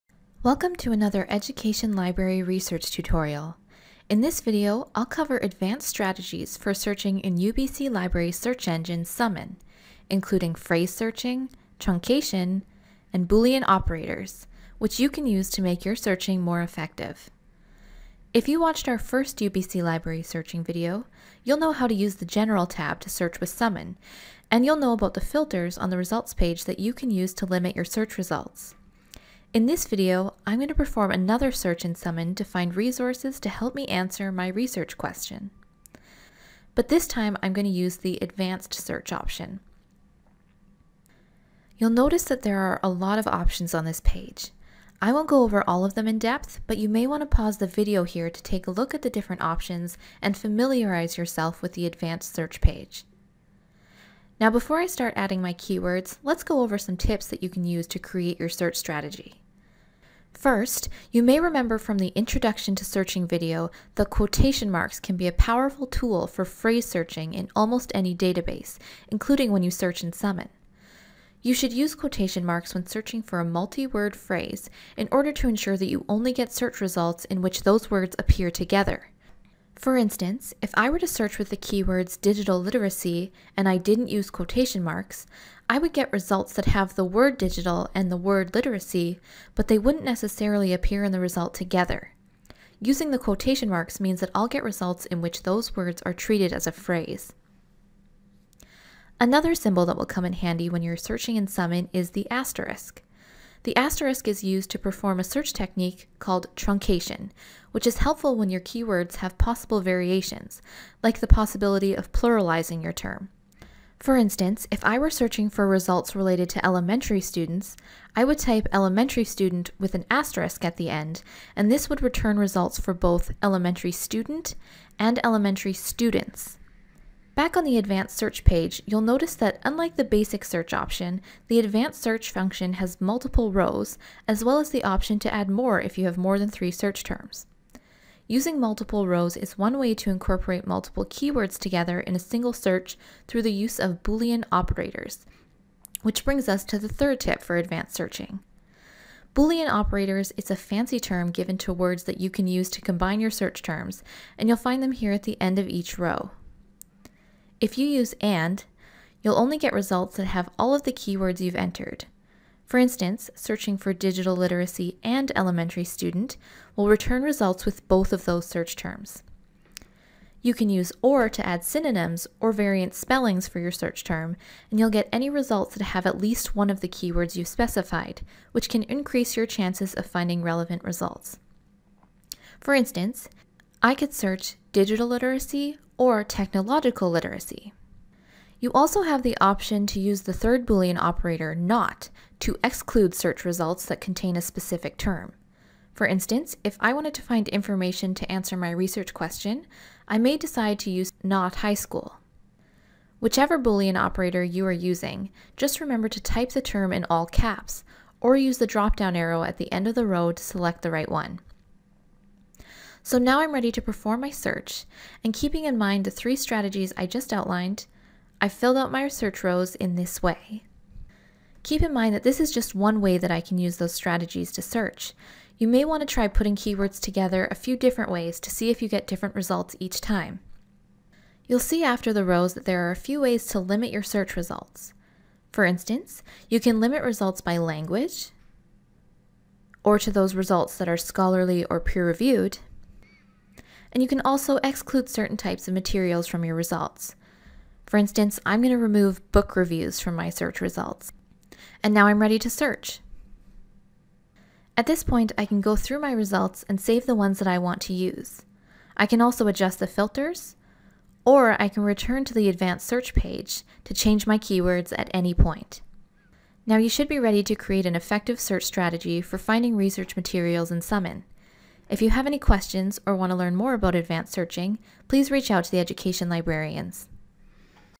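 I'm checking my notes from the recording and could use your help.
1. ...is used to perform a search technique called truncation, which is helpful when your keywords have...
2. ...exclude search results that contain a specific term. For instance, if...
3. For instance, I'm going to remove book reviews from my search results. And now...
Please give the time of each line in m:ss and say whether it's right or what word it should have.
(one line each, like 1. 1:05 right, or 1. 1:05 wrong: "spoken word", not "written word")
1. 1:44 right
2. 3:12 right
3. 4:07 right.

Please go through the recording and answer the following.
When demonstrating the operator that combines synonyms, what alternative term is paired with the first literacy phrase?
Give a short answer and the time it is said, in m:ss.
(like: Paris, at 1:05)
Technological literacy, at 3:06.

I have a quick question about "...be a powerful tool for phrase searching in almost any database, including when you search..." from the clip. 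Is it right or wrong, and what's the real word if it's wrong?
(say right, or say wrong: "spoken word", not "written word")
right.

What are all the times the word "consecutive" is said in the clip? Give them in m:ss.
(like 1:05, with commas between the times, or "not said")
not said.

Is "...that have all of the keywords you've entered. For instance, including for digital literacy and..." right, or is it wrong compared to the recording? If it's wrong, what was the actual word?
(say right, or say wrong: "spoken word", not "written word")
wrong: "searching", not "including".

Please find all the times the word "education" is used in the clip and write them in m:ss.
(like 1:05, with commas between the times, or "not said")
0:01, 4:35.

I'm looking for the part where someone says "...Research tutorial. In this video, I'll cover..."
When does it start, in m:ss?
0:02.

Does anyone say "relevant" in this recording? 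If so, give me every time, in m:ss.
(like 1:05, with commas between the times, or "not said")
3:00.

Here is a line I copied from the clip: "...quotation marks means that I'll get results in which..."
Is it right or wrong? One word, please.
right.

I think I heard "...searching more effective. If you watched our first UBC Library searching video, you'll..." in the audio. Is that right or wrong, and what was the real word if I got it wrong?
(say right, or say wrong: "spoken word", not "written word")
right.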